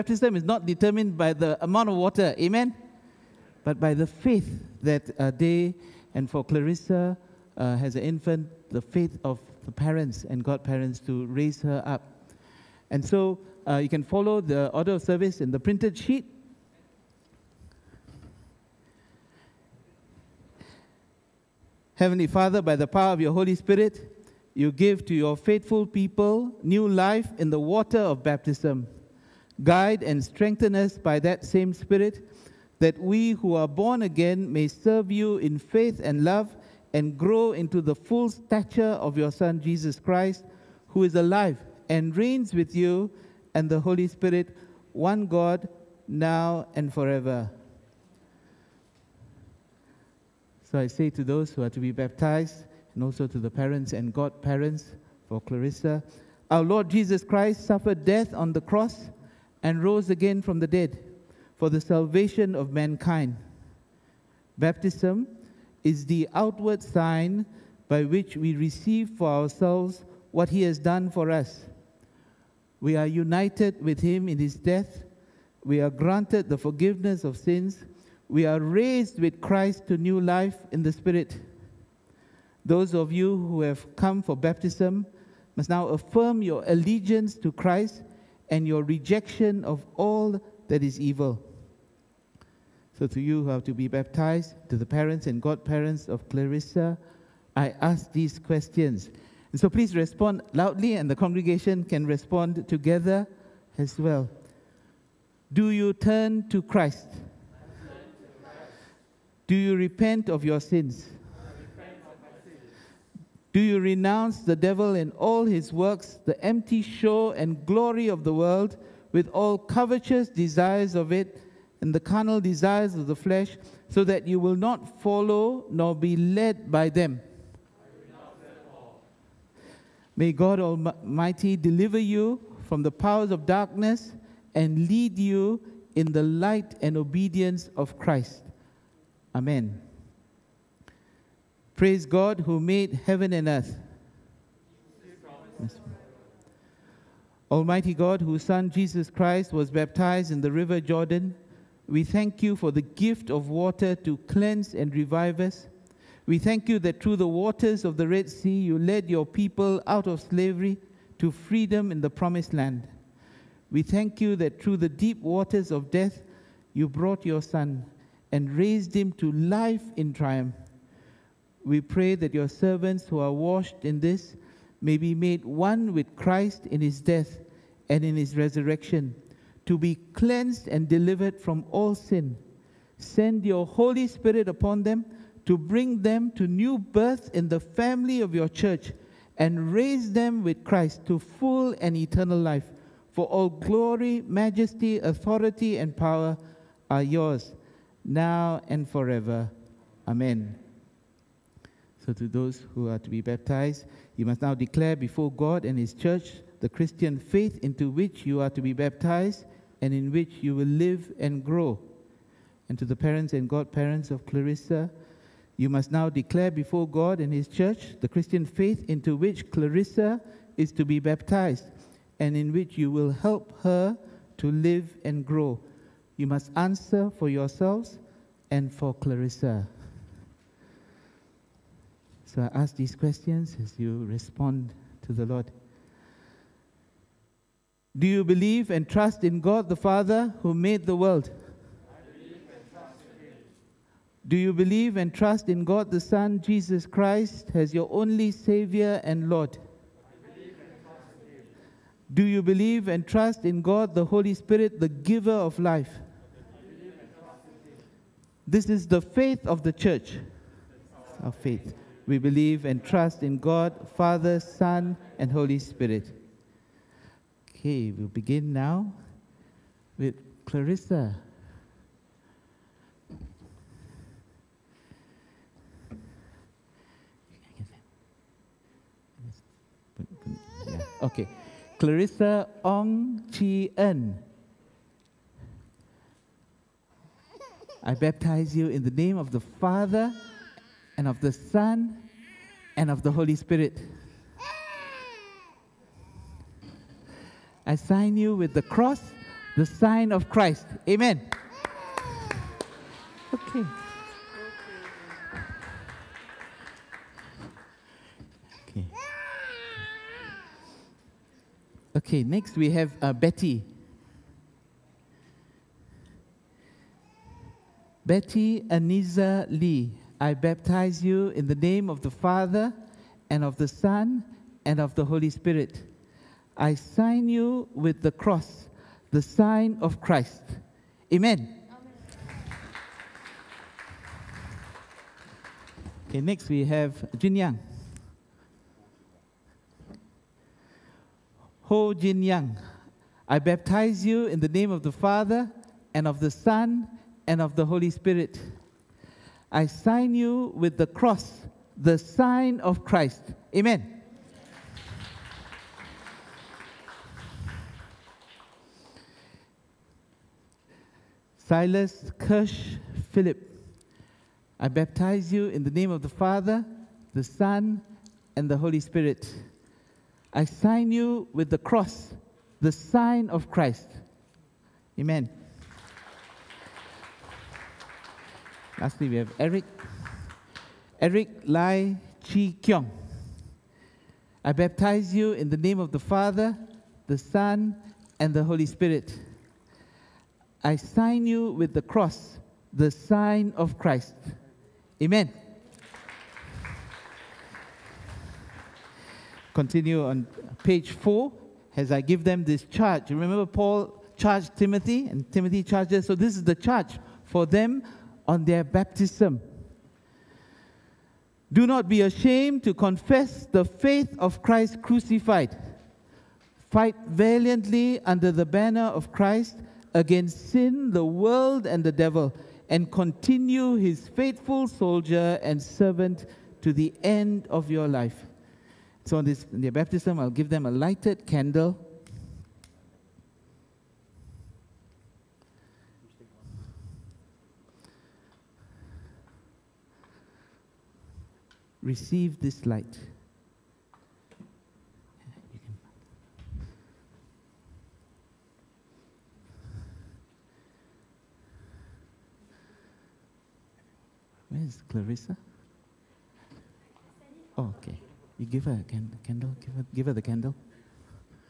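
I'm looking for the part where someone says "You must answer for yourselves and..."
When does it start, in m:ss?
3:46.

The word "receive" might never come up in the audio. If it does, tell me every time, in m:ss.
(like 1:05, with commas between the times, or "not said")
1:08, 7:21.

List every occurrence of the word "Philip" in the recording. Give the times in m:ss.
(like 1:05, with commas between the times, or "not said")
6:03.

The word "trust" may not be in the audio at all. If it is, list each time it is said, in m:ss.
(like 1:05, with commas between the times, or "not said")
3:58, 4:05, 4:13, 4:22.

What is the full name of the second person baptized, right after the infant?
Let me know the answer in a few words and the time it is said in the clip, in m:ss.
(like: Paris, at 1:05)
Betty Aniza Lee, at 5:18.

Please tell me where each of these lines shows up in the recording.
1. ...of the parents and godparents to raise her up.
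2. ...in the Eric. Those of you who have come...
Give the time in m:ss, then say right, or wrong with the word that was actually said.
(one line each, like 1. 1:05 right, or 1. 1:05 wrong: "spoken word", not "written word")
1. 0:09 right
2. 1:20 wrong: "Spirit", not "Eric".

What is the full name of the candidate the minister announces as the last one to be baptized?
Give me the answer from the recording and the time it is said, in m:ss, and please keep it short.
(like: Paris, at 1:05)
Eric Lai Chi Kiong, at 6:20.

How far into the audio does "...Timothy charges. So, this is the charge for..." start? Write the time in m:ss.
6:45.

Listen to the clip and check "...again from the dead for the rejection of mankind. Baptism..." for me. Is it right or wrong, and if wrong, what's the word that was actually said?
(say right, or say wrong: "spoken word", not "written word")
wrong: "salvation", not "rejection".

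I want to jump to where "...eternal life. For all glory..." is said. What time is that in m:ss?
3:11.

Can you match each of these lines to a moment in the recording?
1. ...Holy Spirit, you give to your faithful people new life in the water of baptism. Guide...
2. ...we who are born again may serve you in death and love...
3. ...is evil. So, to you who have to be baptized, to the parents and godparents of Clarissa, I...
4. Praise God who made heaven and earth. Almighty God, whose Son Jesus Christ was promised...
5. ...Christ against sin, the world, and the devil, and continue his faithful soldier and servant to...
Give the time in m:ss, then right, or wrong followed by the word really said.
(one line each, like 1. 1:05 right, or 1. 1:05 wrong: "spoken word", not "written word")
1. 0:23 right
2. 0:33 wrong: "faith", not "death"
3. 1:30 right
4. 2:21 wrong: "baptized", not "promised"
5. 6:59 right.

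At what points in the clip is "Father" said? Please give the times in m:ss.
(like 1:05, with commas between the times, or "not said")
0:22, 3:59, 4:23, 4:49, 5:22, 5:44, 6:06, 6:25.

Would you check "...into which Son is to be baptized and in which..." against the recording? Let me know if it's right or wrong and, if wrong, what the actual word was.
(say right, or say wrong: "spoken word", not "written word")
wrong: "Clarissa", not "Son".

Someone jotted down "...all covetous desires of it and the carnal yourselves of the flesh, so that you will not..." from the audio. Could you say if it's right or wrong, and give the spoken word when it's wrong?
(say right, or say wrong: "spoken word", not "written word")
wrong: "desires", not "yourselves".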